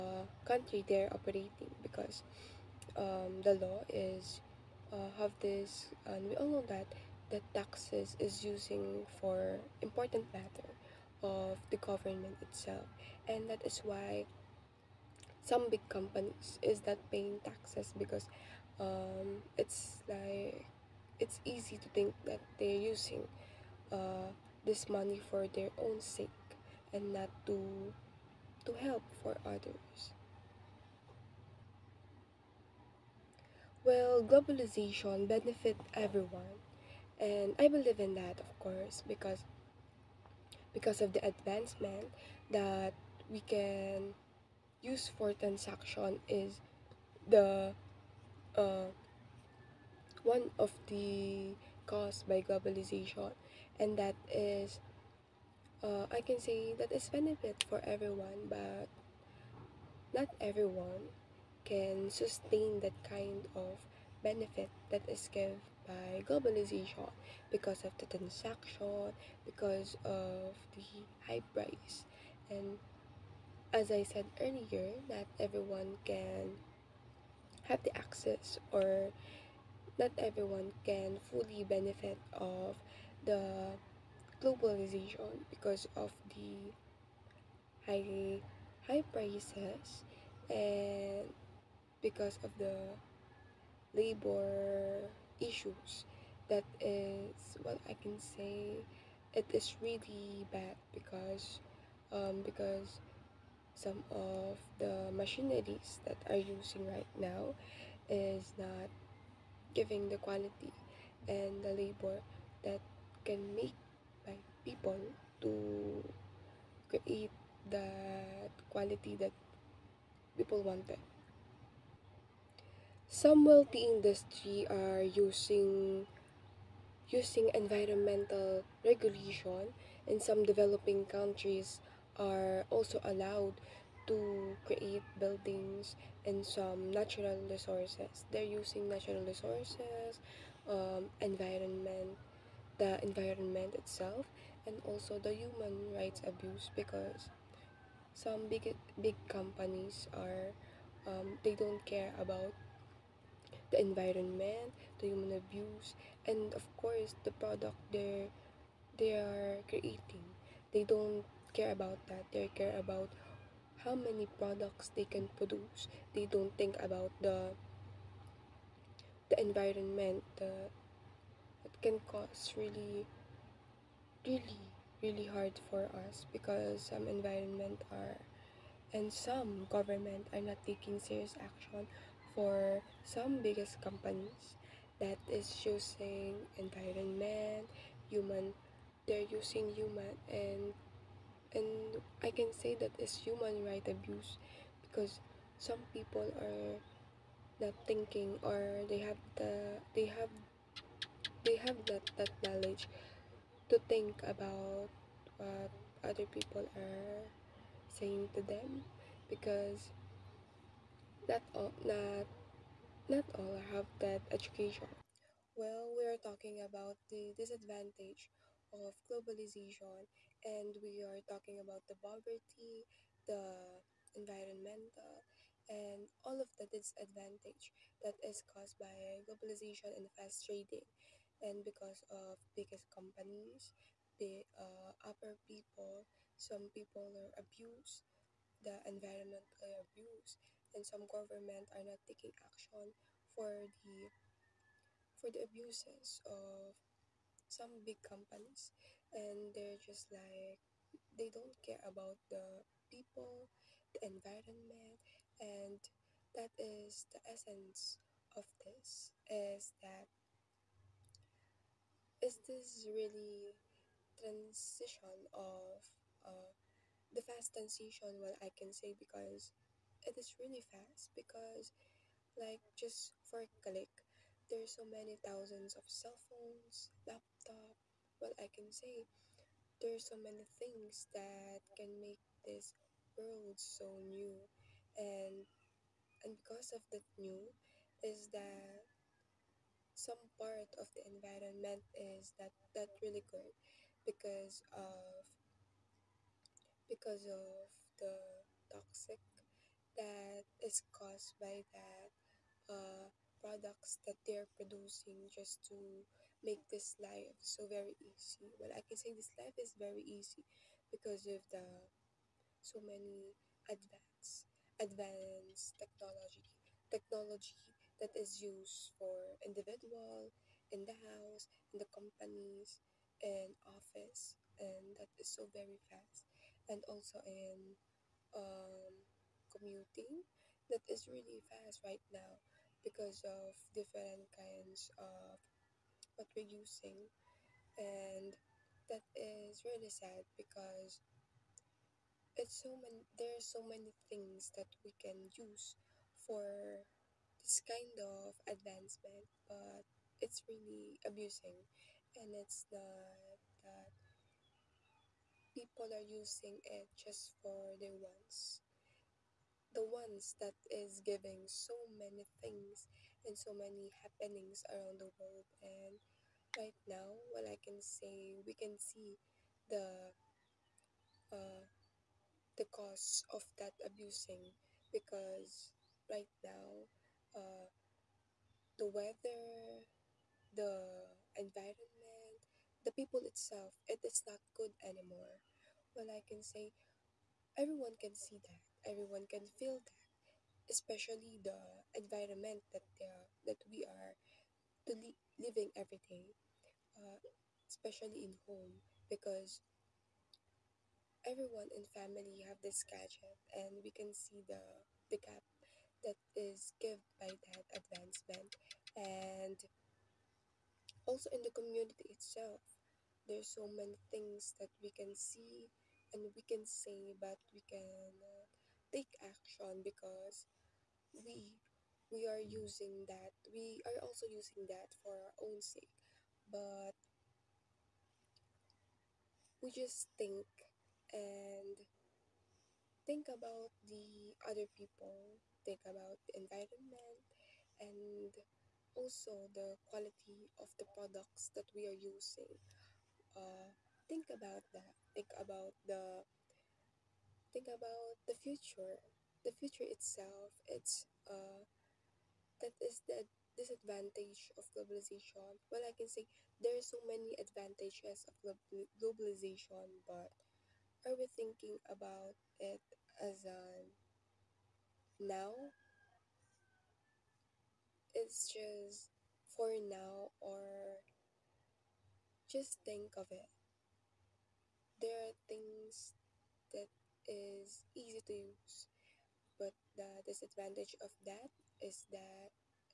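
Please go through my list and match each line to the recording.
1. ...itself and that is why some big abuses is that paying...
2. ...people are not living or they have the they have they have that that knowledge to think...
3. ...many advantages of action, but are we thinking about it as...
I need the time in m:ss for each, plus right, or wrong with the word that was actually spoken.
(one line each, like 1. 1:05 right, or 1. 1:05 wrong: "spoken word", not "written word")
1. 0:12 wrong: "companies", not "abuses"
2. 3:15 wrong: "thinking", not "living"
3. 7:37 wrong: "globalization", not "action".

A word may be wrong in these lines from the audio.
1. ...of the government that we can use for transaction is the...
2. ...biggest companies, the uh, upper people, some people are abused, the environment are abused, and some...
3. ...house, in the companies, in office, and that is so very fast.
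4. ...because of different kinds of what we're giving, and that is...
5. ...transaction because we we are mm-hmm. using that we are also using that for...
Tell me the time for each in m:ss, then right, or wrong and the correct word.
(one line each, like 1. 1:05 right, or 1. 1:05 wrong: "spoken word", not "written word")
1. 0:41 wrong: "advancement", not "government"
2. 3:52 right
3. 5:21 right
4. 5:32 wrong: "using", not "giving"
5. 6:59 wrong: "action", not "transaction".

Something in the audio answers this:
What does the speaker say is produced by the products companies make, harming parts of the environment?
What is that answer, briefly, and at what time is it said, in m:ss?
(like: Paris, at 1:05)
toxic, at 4:58.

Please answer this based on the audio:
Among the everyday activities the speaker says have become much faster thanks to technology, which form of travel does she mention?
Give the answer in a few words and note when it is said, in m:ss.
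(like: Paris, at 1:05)
commuting, at 5:29.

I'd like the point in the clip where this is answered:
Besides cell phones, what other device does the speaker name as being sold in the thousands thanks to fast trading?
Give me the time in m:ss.
4:37.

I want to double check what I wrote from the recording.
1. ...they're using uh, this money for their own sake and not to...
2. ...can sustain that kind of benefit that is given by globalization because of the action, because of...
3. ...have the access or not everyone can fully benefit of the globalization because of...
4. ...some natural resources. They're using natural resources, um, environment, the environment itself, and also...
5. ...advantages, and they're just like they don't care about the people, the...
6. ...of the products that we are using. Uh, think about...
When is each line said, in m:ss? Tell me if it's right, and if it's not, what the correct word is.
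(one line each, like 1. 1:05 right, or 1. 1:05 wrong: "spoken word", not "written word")
1. 0:22 right
2. 1:01 wrong: "transaction", not "action"
3. 1:17 right
4. 2:16 right
5. 4:08 wrong: "companies", not "advantages"
6. 7:20 right.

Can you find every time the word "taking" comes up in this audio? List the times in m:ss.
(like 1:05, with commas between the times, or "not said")
3:00, 4:02.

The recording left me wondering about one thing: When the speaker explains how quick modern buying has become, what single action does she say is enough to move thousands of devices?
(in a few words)
a click.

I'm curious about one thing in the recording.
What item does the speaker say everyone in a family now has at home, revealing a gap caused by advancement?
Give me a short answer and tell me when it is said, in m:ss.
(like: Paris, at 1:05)
gadget, at 6:42.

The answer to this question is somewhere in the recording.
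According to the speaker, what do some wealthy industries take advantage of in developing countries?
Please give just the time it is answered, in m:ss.
2:07.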